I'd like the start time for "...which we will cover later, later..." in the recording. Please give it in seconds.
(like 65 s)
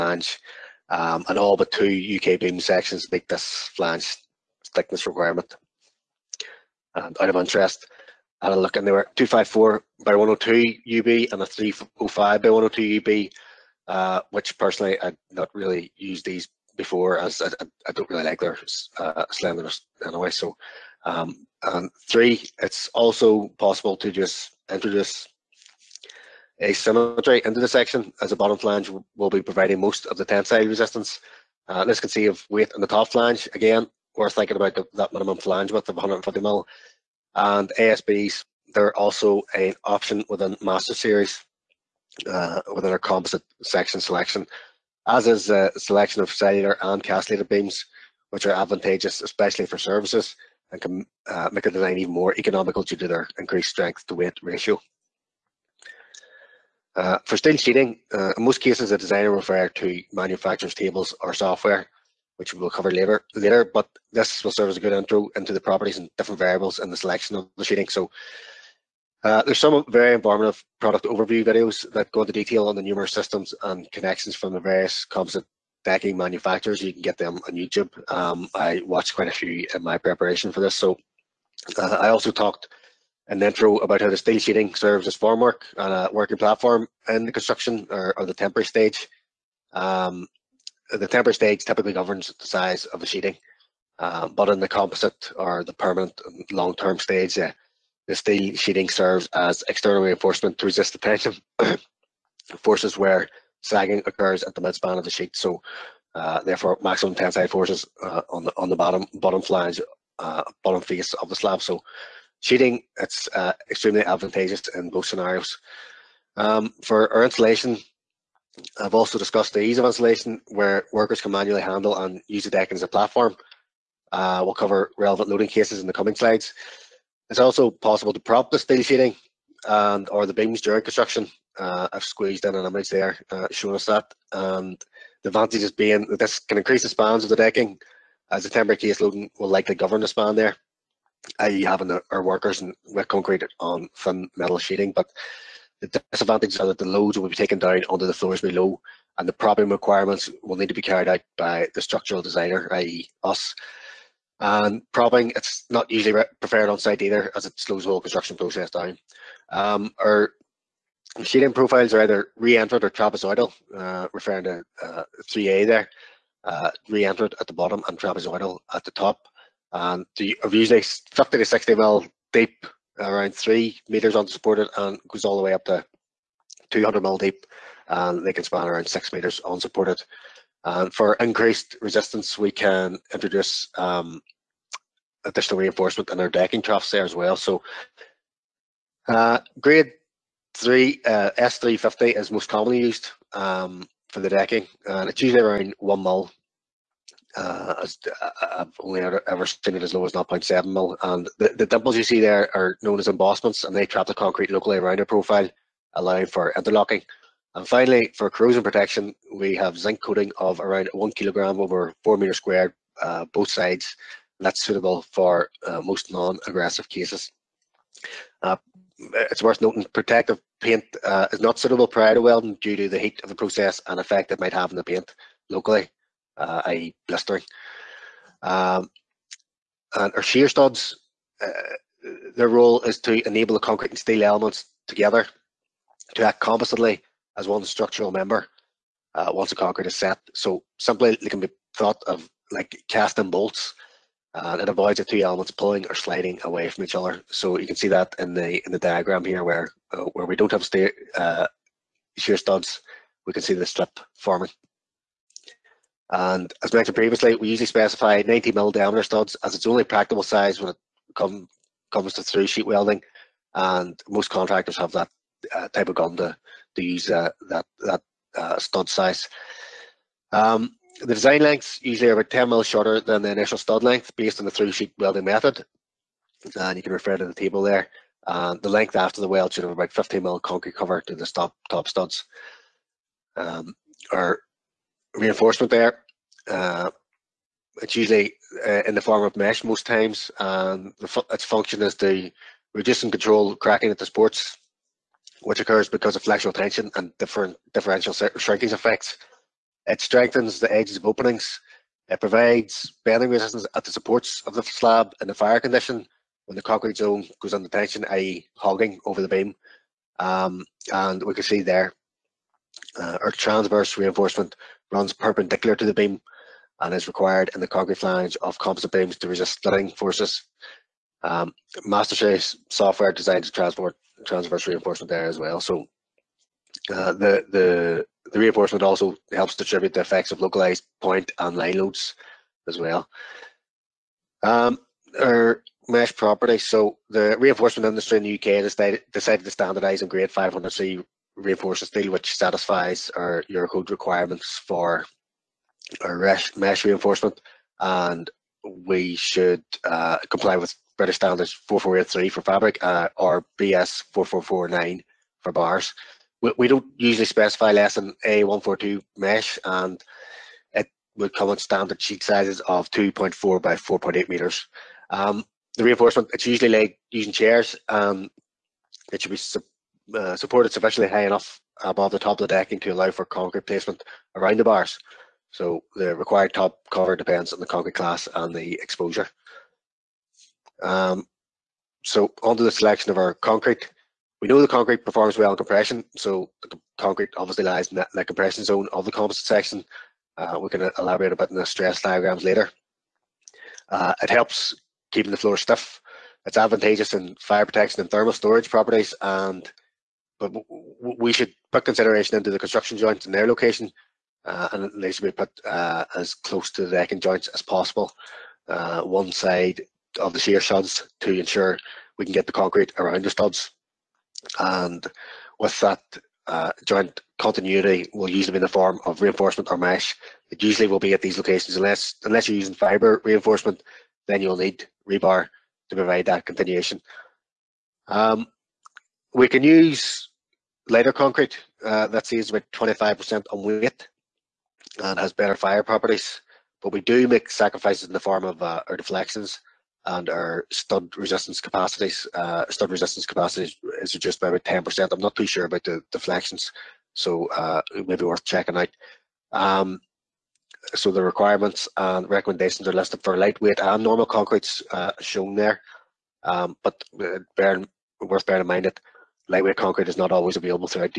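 62 s.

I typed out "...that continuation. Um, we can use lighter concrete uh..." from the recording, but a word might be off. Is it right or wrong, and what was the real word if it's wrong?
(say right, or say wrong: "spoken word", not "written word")
right.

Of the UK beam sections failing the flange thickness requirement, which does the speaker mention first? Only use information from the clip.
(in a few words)
254 by 102 UB.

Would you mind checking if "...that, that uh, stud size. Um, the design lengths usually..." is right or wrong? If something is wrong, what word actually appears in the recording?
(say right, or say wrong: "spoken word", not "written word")
right.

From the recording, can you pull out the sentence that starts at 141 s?
having our workers in, with concrete on thin metal sheeting.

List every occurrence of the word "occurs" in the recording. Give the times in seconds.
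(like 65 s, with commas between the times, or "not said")
104 s, 295 s.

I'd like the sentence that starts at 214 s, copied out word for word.
And that's suitable for uh, most non-aggressive cases.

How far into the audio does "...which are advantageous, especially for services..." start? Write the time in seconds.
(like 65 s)
48 s.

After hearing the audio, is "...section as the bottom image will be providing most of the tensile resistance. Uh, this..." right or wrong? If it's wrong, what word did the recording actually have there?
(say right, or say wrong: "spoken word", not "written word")
wrong: "flange", not "image".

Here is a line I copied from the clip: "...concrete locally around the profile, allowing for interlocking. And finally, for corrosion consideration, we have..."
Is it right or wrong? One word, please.
wrong.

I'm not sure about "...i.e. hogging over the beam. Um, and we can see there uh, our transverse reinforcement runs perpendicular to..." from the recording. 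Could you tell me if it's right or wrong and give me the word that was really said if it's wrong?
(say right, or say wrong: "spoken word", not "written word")
right.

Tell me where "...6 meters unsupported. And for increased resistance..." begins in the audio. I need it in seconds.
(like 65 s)
178 s.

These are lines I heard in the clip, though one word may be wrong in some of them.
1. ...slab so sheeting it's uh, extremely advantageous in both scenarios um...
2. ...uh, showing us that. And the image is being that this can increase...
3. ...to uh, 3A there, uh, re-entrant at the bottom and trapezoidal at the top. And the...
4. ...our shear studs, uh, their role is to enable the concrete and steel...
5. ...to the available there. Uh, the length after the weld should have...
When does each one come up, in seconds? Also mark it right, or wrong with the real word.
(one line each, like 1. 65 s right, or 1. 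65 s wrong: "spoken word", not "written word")
1. 111 s right
2. 133 s wrong: "advantage", not "image"
3. 164 s right
4. 230 s right
5. 277 s wrong: "table", not "available".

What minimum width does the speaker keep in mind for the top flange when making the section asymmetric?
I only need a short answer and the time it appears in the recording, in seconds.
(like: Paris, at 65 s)
150 mm, at 35 s.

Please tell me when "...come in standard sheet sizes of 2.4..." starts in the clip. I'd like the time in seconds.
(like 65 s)
361 s.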